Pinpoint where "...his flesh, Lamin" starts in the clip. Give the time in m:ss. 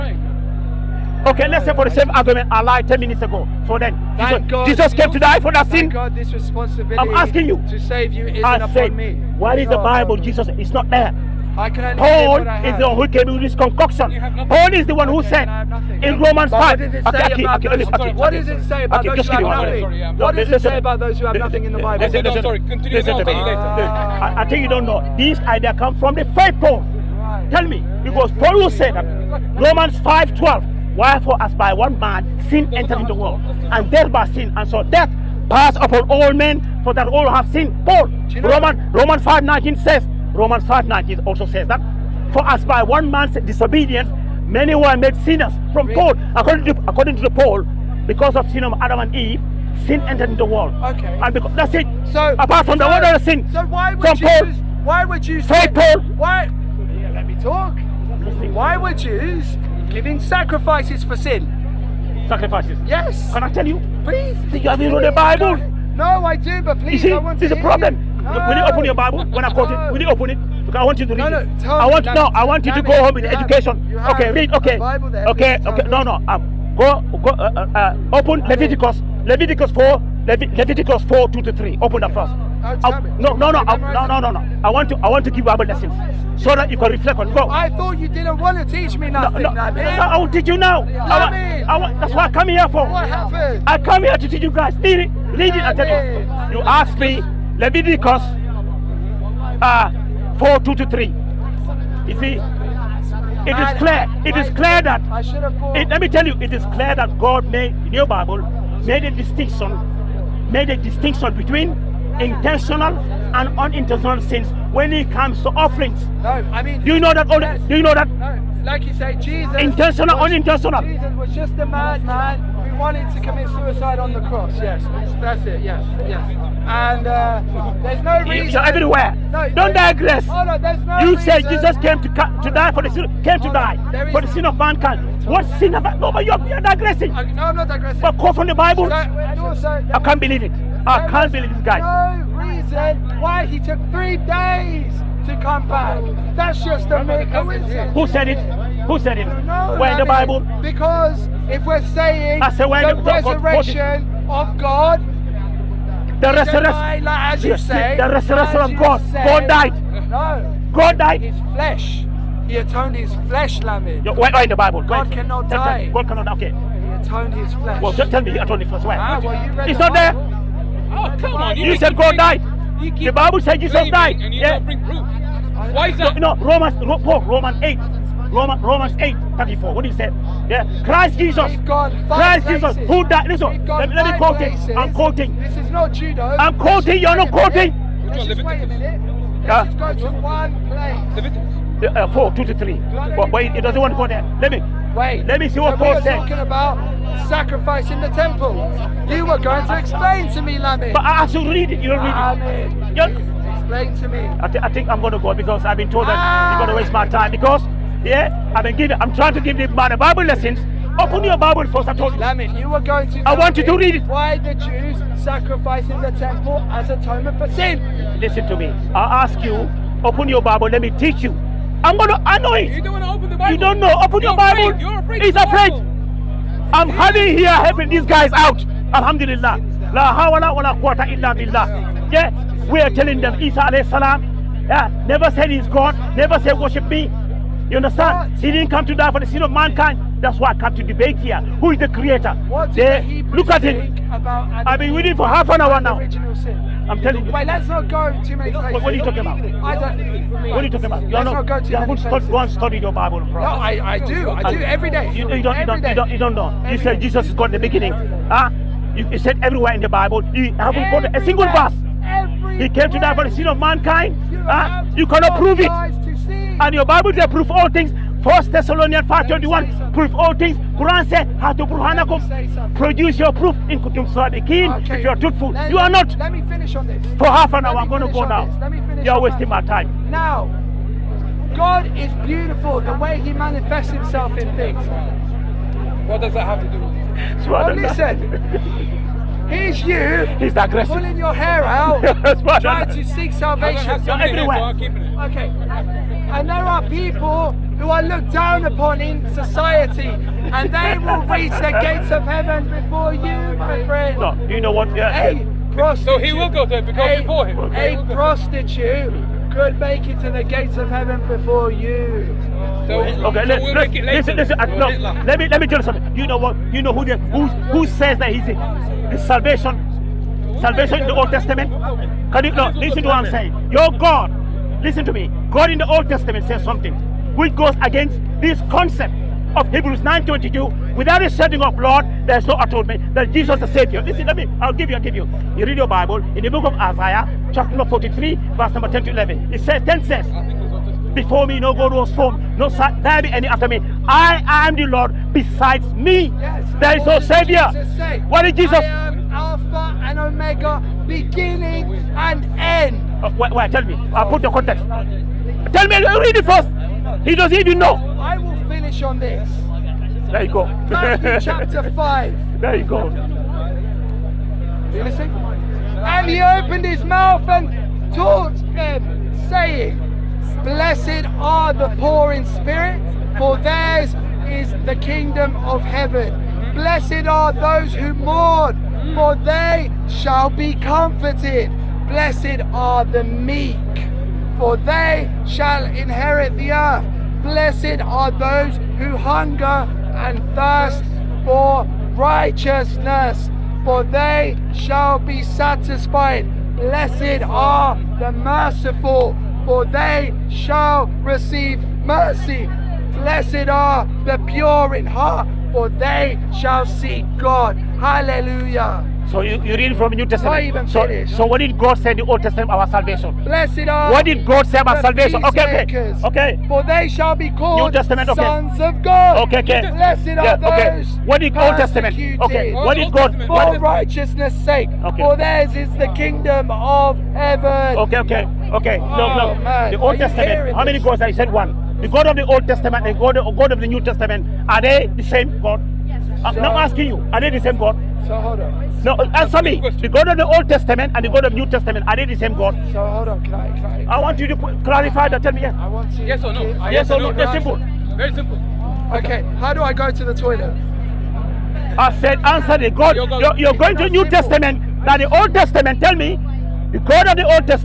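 2:42.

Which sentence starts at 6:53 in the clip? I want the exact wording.
Blessed are What did God say about salvation?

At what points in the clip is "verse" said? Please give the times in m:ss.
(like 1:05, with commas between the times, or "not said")
4:21, 5:38.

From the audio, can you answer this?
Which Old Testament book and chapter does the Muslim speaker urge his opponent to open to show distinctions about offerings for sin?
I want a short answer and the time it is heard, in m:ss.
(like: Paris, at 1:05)
Leviticus 4, at 1:18.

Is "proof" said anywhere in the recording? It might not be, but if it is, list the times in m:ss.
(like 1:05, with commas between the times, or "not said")
2:54, 4:33.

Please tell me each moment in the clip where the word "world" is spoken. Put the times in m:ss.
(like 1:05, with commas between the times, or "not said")
0:33, 0:50.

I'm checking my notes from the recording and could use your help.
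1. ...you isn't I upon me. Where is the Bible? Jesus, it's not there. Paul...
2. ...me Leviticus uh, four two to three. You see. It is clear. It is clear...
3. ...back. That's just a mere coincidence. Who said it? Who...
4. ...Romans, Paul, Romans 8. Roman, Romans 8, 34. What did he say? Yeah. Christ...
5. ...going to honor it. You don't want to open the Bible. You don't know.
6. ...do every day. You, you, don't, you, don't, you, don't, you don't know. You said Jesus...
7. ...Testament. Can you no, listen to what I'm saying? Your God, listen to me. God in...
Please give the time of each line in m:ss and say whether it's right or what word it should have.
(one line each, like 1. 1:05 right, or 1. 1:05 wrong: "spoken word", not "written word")
1. 0:08 right
2. 1:36 right
3. 2:25 right
4. 2:56 right
5. 3:41 right
6. 4:14 right
7. 5:21 right.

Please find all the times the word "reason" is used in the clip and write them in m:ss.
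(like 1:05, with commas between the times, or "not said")
2:08, 2:22.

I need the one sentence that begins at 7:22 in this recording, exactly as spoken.
So hold on, can I, can I, I want you to clarify that.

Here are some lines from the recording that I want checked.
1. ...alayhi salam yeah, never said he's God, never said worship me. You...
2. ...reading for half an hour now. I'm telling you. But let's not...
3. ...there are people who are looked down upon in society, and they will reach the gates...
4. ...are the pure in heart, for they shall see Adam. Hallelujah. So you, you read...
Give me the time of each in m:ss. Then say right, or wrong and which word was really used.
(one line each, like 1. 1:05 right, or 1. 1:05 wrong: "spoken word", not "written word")
1. 3:53 right
2. 4:04 right
3. 4:56 right
4. 6:43 wrong: "God", not "Adam".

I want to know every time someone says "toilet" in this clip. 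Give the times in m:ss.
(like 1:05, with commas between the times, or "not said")
7:30.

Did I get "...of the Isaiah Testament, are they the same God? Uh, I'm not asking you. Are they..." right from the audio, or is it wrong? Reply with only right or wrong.
wrong.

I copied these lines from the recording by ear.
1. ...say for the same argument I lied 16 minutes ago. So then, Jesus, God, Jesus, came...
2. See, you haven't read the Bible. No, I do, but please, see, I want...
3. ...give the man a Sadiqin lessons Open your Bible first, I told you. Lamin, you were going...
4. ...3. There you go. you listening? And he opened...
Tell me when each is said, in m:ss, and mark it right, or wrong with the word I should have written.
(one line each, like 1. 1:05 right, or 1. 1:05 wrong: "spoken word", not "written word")
1. 0:01 wrong: "10", not "16"
2. 1:04 right
3. 3:29 wrong: "Bible", not "Sadiqin"
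4. 6:01 wrong: "5", not "3".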